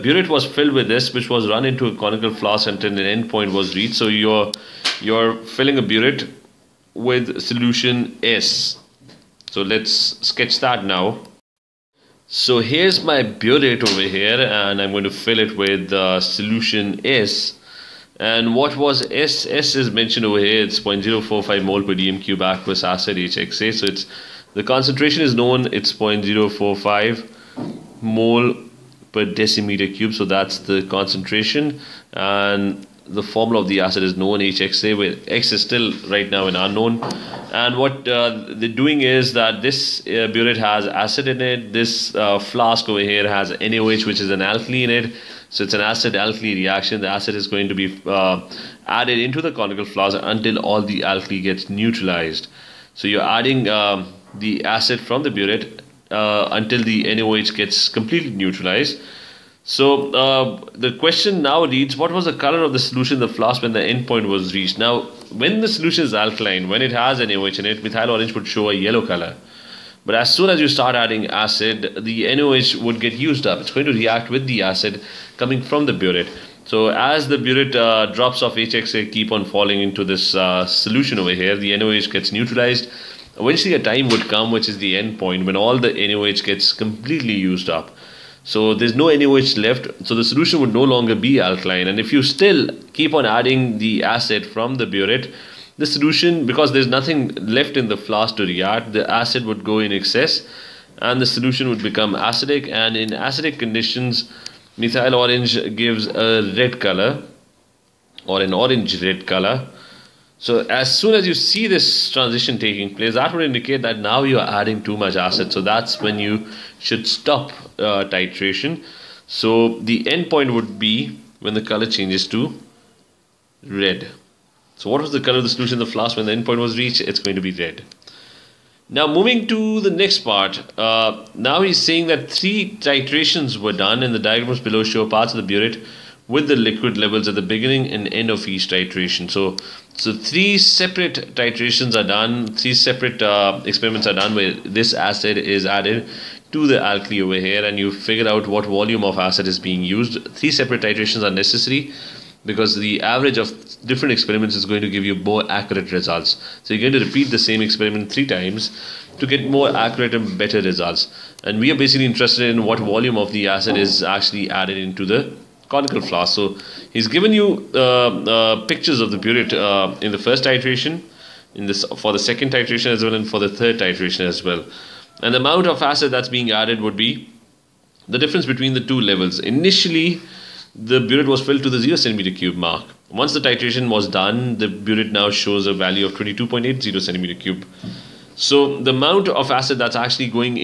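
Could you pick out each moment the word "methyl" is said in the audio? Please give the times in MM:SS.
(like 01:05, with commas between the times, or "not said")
01:07, 01:44.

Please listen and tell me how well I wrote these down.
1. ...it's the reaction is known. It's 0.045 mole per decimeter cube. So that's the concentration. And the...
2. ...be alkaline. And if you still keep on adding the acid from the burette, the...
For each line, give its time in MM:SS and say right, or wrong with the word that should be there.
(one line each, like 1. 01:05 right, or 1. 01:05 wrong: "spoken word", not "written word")
1. 00:23 wrong: "concentration", not "reaction"
2. 01:31 right.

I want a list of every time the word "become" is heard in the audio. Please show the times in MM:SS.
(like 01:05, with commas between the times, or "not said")
01:41.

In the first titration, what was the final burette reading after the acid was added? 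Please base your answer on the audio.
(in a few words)
22.80 cm³.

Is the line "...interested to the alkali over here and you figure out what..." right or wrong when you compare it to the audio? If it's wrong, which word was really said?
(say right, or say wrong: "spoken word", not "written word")
wrong: "added", not "interested".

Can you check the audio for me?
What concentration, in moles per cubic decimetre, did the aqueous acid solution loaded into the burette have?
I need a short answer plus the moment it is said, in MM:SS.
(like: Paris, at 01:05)
0.045 mol/dm³, at 00:20.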